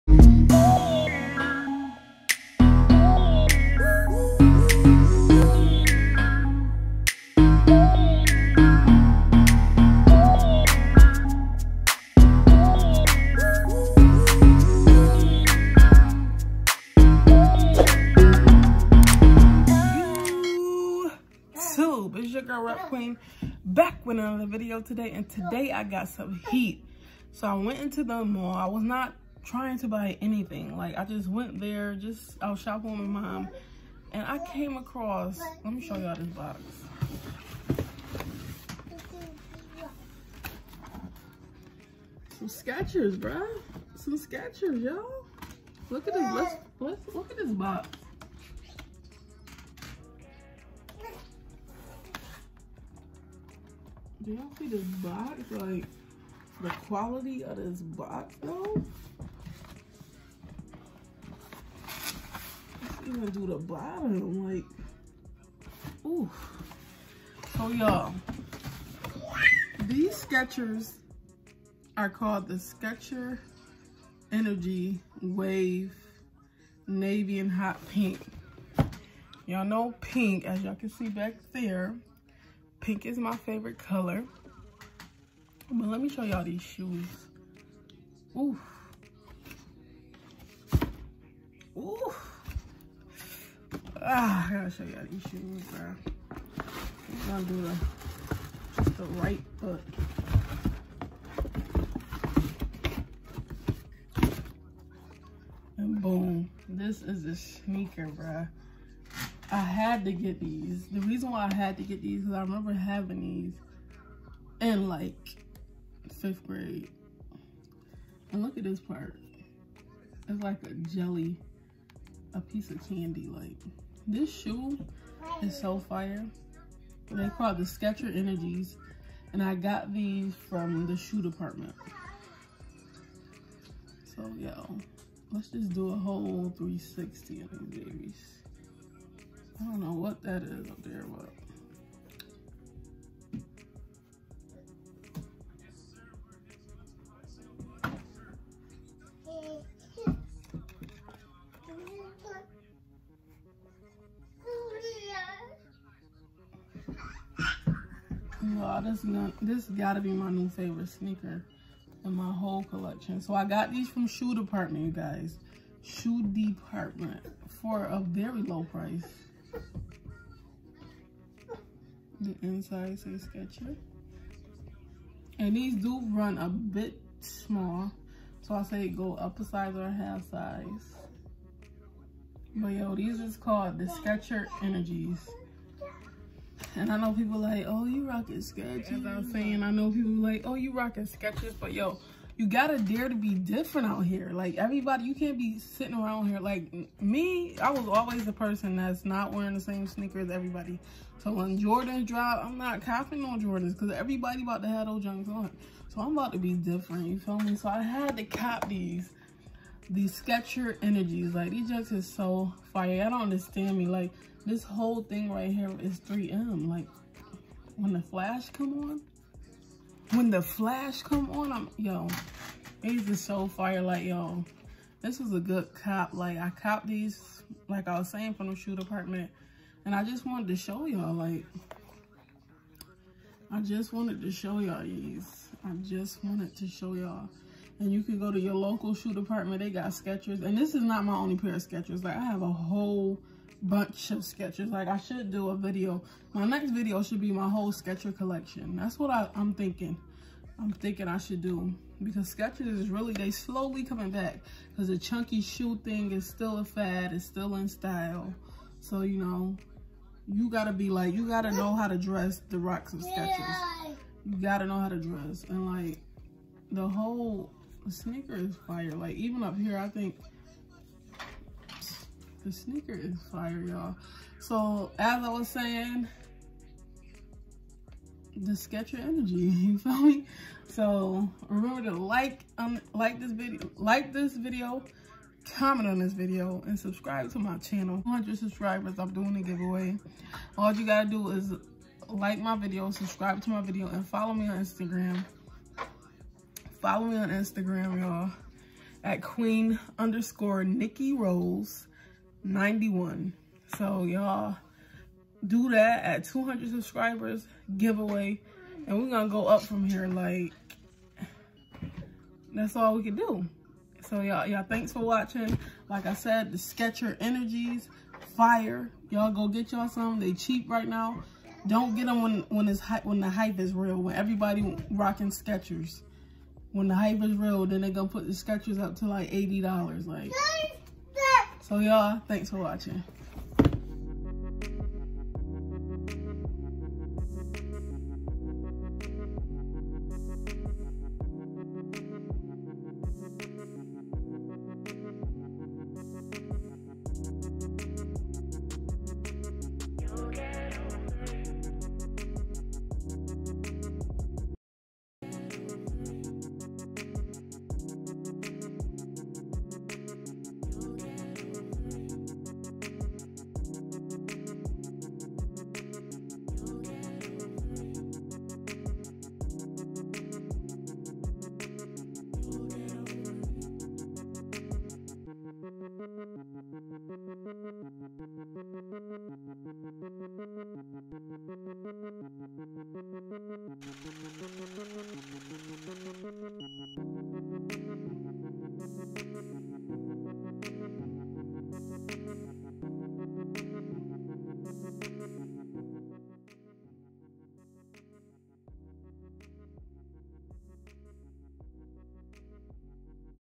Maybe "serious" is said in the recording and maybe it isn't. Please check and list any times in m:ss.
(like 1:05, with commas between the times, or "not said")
not said.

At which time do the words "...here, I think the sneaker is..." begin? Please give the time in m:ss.
4:29.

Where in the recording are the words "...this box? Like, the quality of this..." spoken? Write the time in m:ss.
0:54.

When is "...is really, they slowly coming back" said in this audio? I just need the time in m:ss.
4:12.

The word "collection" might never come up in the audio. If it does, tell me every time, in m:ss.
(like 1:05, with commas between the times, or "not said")
2:42, 4:08.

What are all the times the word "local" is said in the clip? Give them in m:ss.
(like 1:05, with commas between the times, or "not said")
3:58.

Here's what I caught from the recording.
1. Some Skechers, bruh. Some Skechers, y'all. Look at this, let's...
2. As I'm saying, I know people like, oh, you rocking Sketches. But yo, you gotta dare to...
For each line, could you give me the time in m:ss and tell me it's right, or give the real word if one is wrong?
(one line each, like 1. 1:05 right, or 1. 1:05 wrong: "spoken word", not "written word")
1. 0:42 right
2. 3:09 right.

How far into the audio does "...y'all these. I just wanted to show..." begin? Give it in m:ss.
3:54.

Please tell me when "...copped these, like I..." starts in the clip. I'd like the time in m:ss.
3:46.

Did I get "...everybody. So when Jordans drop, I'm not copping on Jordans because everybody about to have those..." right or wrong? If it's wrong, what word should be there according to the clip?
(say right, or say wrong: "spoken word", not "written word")
right.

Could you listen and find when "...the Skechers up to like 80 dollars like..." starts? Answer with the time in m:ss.
5:28.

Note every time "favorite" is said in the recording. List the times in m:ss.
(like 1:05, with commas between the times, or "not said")
1:23, 2:40.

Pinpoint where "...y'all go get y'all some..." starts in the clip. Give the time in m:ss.
5:19.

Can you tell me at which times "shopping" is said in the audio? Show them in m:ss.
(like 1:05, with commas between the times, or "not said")
0:32.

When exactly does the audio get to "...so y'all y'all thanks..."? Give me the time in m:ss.
5:14.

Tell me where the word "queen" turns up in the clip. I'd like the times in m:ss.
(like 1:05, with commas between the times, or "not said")
0:22, 4:59.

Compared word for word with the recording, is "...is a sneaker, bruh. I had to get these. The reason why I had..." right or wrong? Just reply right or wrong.
right.